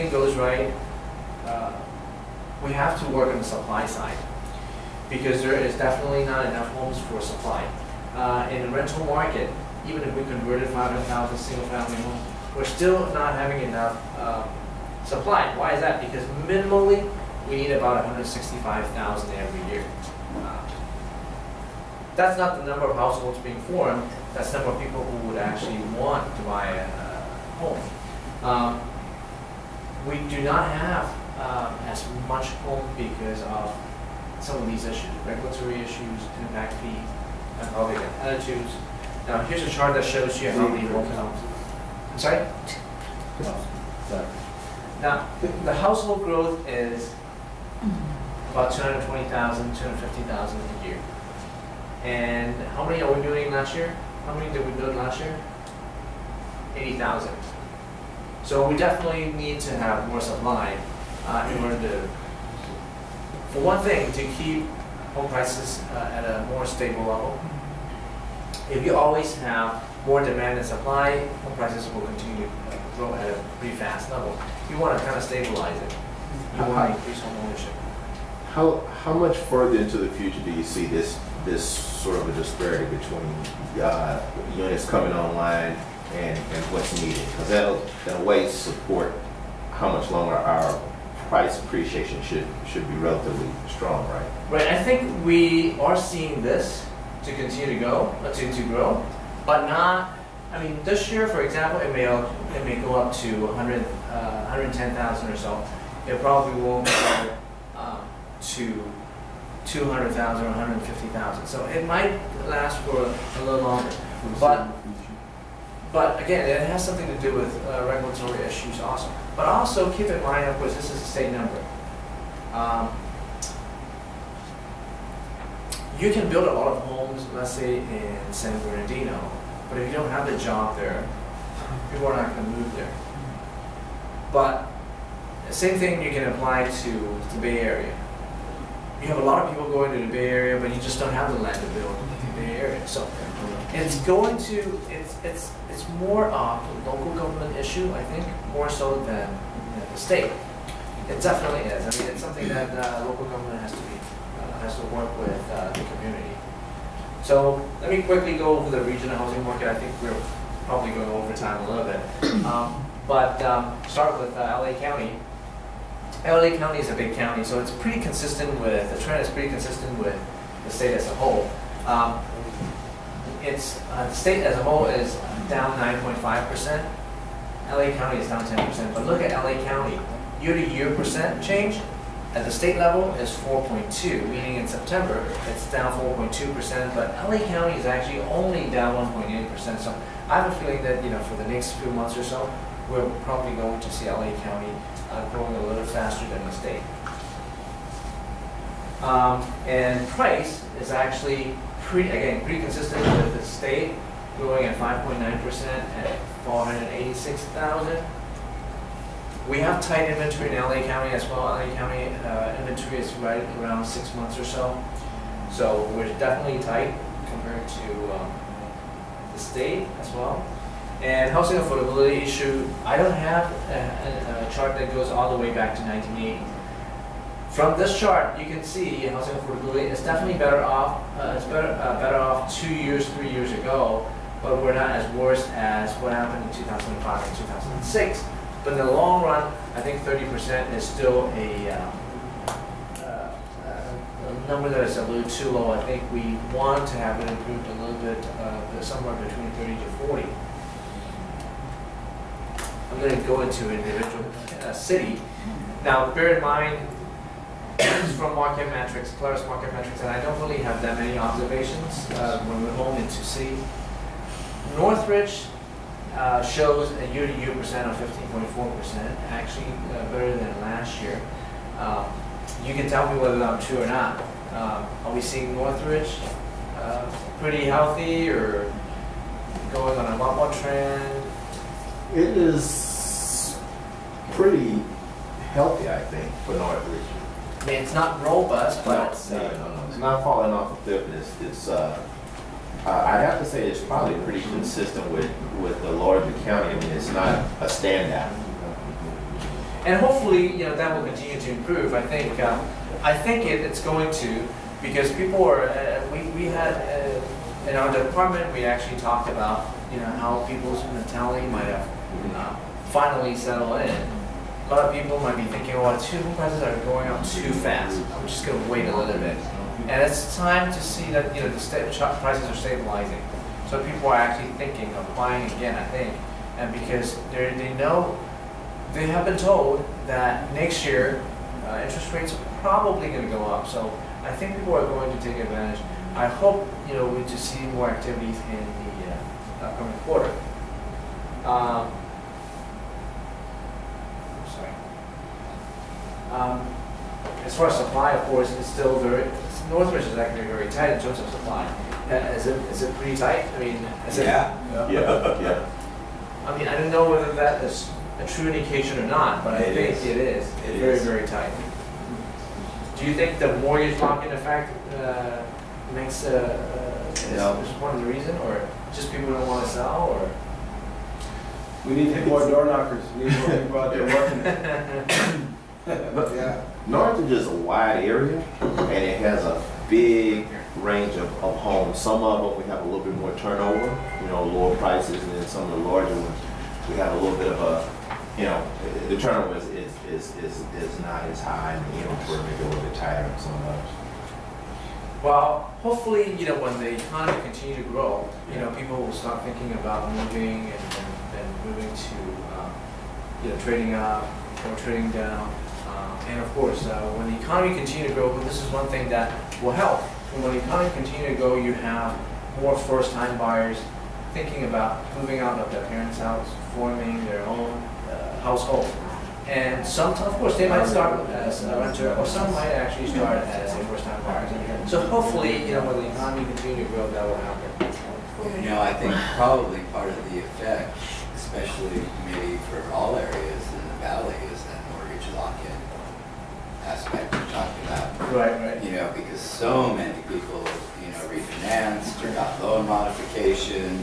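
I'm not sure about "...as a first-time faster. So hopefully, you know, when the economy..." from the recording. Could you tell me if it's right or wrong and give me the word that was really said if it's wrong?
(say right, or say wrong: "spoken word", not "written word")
wrong: "buyer", not "faster".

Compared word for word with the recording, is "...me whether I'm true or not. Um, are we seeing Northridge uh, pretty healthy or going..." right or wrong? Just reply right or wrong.
right.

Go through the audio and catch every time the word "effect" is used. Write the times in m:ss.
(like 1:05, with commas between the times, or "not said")
6:04, 7:10.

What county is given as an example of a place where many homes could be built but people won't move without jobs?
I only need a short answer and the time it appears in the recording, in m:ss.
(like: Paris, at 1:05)
San Bernardino, at 2:08.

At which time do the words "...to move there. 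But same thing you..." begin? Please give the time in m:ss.
2:12.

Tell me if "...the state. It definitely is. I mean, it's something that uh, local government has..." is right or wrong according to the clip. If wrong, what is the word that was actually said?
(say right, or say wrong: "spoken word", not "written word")
right.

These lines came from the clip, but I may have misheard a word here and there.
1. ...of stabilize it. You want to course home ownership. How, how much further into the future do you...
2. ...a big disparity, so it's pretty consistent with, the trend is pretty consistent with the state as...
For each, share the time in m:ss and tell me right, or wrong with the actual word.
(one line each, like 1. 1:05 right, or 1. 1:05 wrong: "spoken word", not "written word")
1. 1:15 wrong: "increase", not "course"
2. 2:46 wrong: "county", not "disparity".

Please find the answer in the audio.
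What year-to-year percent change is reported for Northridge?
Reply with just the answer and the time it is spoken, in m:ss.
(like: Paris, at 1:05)
15.4%, at 4:27.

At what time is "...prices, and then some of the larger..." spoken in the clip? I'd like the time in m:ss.
6:24.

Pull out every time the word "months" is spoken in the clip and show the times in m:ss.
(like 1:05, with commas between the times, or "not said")
3:11, 3:34.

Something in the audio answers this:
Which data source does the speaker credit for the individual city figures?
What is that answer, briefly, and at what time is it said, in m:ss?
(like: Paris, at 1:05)
Polaris Market Metrics, at 4:19.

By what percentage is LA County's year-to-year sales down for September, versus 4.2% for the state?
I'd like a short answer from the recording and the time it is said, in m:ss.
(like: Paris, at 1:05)
1.8%, at 3:08.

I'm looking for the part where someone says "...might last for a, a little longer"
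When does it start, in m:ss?
1:51.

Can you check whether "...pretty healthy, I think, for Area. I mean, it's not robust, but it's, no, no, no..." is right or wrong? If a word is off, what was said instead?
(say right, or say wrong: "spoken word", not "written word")
wrong: "Northridge", not "Area".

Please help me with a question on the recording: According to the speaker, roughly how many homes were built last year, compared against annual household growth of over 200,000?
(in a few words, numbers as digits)
80,000.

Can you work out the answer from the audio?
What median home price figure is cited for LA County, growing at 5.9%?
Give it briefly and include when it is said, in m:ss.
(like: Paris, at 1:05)
486,000, at 3:26.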